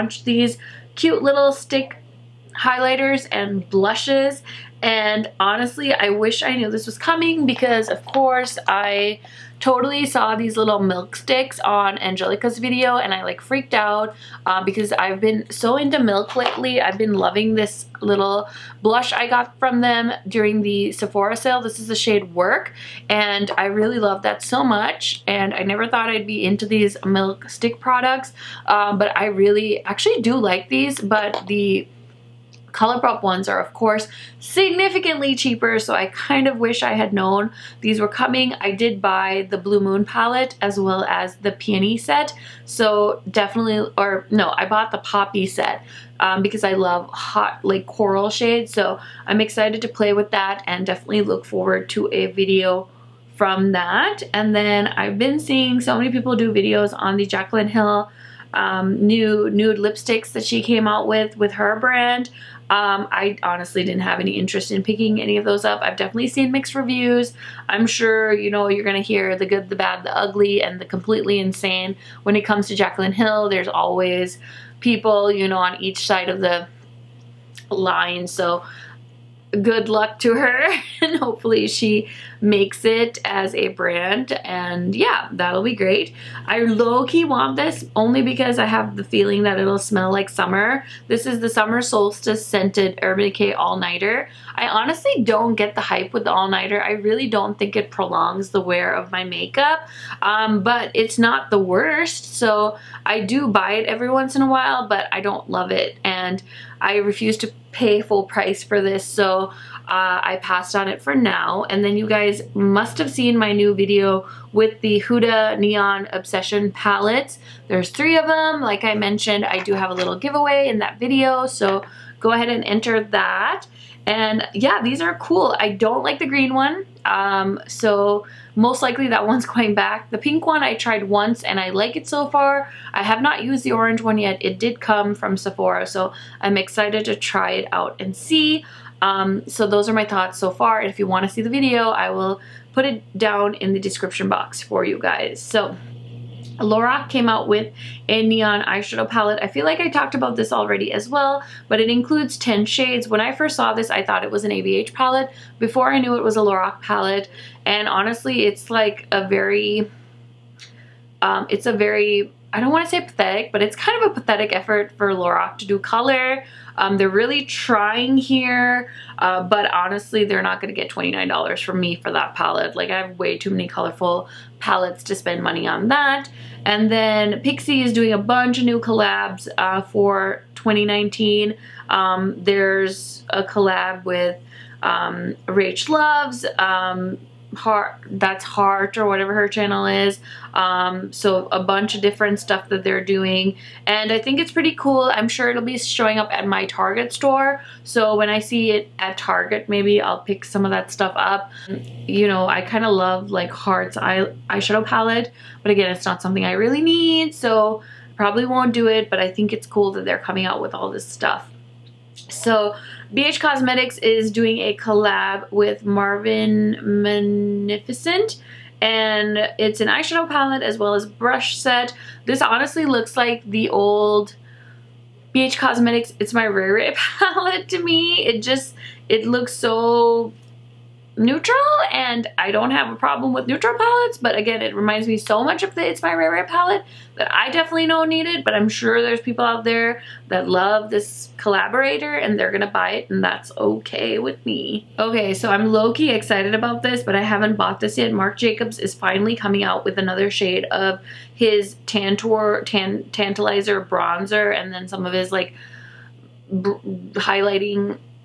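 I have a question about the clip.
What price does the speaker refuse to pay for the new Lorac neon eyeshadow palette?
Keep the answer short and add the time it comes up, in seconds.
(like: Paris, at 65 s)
$29, at 170 s.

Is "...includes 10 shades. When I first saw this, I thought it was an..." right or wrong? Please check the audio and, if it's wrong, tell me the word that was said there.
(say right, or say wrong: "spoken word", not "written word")
right.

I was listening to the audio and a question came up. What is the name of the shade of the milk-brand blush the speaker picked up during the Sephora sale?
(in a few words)
Work.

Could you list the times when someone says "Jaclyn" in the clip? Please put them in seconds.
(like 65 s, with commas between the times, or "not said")
57 s, 72 s.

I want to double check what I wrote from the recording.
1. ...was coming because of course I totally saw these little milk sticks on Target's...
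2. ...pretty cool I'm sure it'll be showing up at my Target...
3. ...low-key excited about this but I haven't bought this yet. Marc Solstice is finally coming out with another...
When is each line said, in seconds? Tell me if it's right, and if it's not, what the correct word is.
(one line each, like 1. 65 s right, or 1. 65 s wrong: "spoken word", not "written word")
1. 6 s wrong: "Angelica", not "Target"
2. 194 s right
3. 245 s wrong: "Jacobs", not "Solstice".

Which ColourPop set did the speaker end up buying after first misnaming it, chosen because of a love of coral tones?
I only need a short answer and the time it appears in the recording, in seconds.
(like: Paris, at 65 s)
Poppy, at 44 s.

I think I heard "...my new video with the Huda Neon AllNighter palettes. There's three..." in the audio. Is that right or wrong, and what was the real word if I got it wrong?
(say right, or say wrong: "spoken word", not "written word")
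wrong: "Obsession", not "AllNighter".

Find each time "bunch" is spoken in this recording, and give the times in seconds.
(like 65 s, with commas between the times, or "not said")
178 s, 191 s.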